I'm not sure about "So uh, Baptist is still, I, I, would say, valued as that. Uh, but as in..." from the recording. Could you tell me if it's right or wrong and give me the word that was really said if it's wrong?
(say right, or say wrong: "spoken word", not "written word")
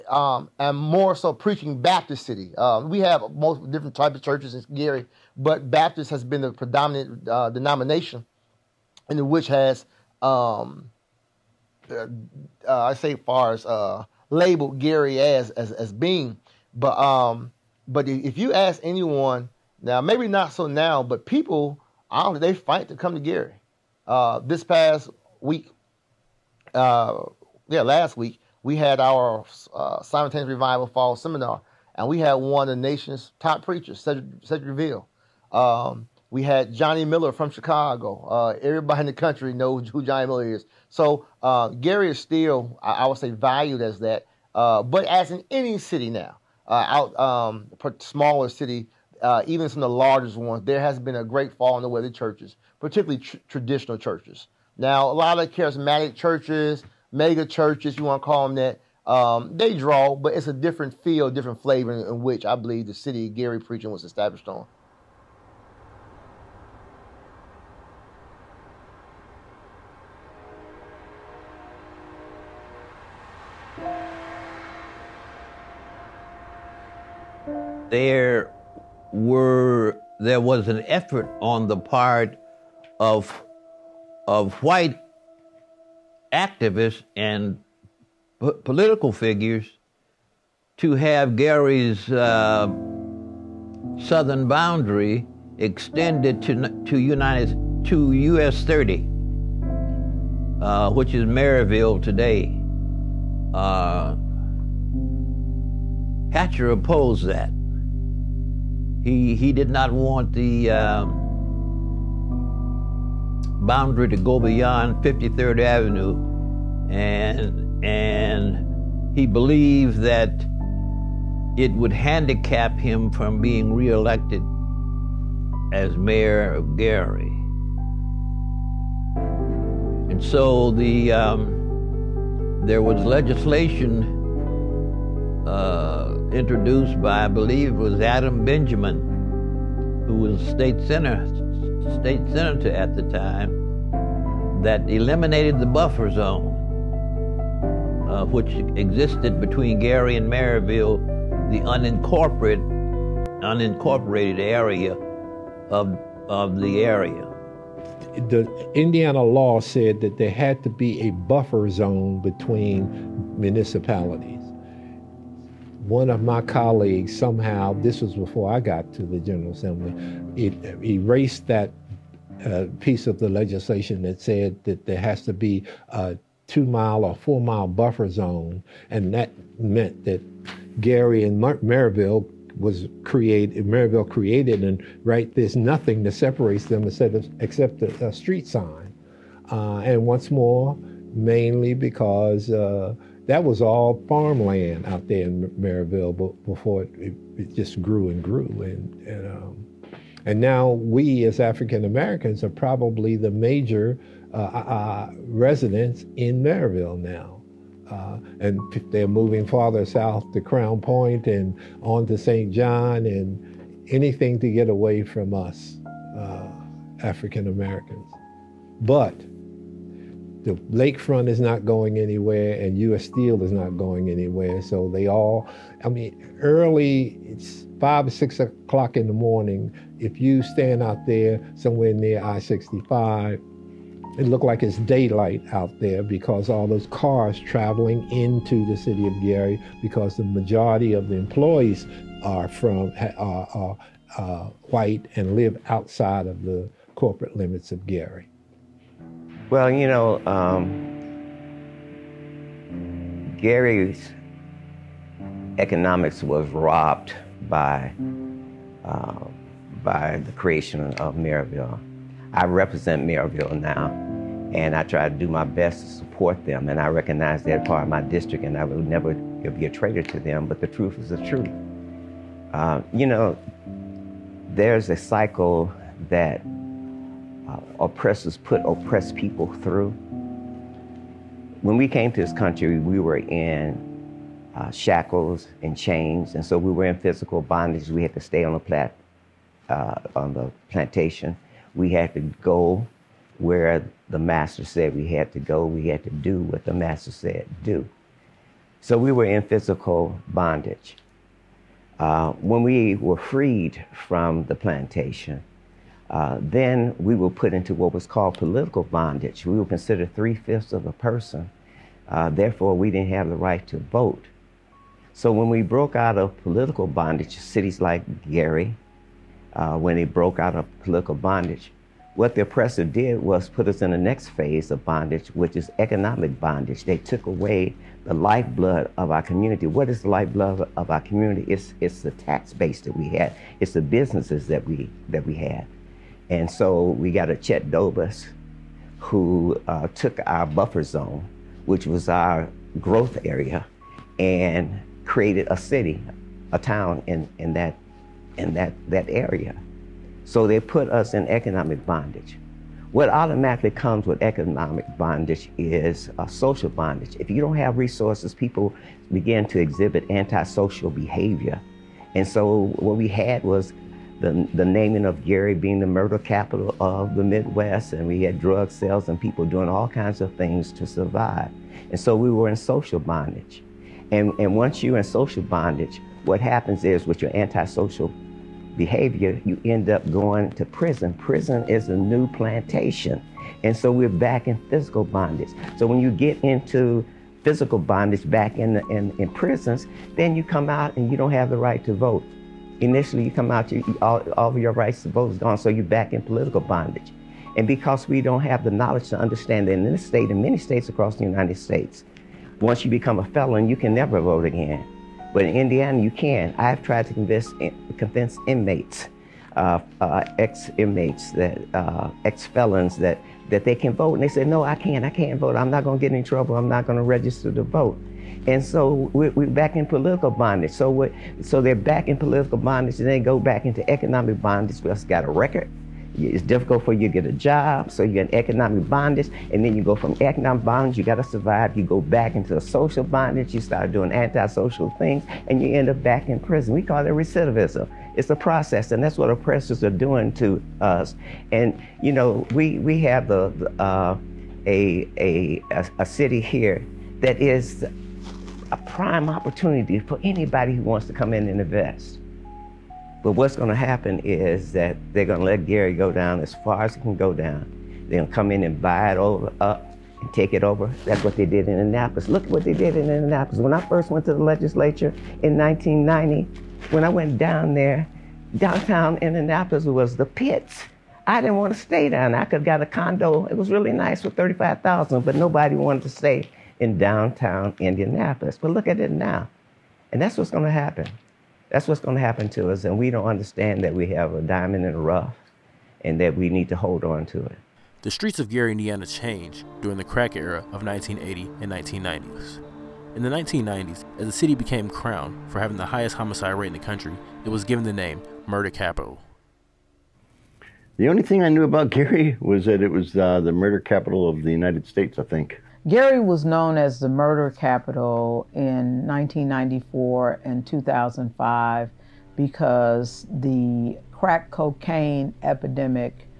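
wrong: "Gary", not "Baptist".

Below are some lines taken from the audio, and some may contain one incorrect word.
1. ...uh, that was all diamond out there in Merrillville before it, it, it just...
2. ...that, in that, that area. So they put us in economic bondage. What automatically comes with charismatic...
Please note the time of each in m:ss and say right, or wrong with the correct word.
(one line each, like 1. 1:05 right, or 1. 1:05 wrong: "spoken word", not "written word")
1. 3:12 wrong: "farmland", not "diamond"
2. 5:47 wrong: "economic", not "charismatic".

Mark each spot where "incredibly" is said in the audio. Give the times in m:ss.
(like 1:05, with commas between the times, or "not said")
not said.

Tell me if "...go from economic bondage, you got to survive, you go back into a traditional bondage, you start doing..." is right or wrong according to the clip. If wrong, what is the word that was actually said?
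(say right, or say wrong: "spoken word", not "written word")
wrong: "social", not "traditional".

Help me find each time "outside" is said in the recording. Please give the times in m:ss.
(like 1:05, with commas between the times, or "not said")
4:05.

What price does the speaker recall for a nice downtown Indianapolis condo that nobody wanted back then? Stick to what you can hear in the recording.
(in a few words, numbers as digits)
$35,000.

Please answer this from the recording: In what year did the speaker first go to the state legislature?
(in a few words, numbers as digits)
1990.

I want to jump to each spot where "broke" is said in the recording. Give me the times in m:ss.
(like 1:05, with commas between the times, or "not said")
5:15, 5:20.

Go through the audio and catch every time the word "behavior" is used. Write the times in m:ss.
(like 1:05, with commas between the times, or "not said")
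6:00, 6:18.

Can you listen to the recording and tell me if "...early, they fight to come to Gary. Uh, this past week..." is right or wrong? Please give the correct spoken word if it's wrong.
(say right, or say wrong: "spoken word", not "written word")
wrong: "honestly", not "early".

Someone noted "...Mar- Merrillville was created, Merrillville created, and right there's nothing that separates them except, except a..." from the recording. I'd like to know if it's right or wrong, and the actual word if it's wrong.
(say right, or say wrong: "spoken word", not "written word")
right.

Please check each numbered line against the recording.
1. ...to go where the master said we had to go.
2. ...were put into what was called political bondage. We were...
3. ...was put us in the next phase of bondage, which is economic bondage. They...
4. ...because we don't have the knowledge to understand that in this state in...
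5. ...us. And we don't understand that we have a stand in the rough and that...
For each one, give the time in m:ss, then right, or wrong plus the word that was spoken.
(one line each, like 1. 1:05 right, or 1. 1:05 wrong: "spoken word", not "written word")
1. 4:52 right
2. 5:07 right
3. 5:23 right
4. 6:37 right
5. 8:02 wrong: "diamond", not "stand".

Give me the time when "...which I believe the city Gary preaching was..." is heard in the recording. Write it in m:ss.
1:02.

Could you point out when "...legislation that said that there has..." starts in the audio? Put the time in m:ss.
2:53.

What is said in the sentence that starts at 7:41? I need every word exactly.
That's what they did in Annapolis.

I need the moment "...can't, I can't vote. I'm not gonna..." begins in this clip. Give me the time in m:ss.
6:54.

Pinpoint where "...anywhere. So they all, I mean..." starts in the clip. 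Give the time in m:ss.
3:44.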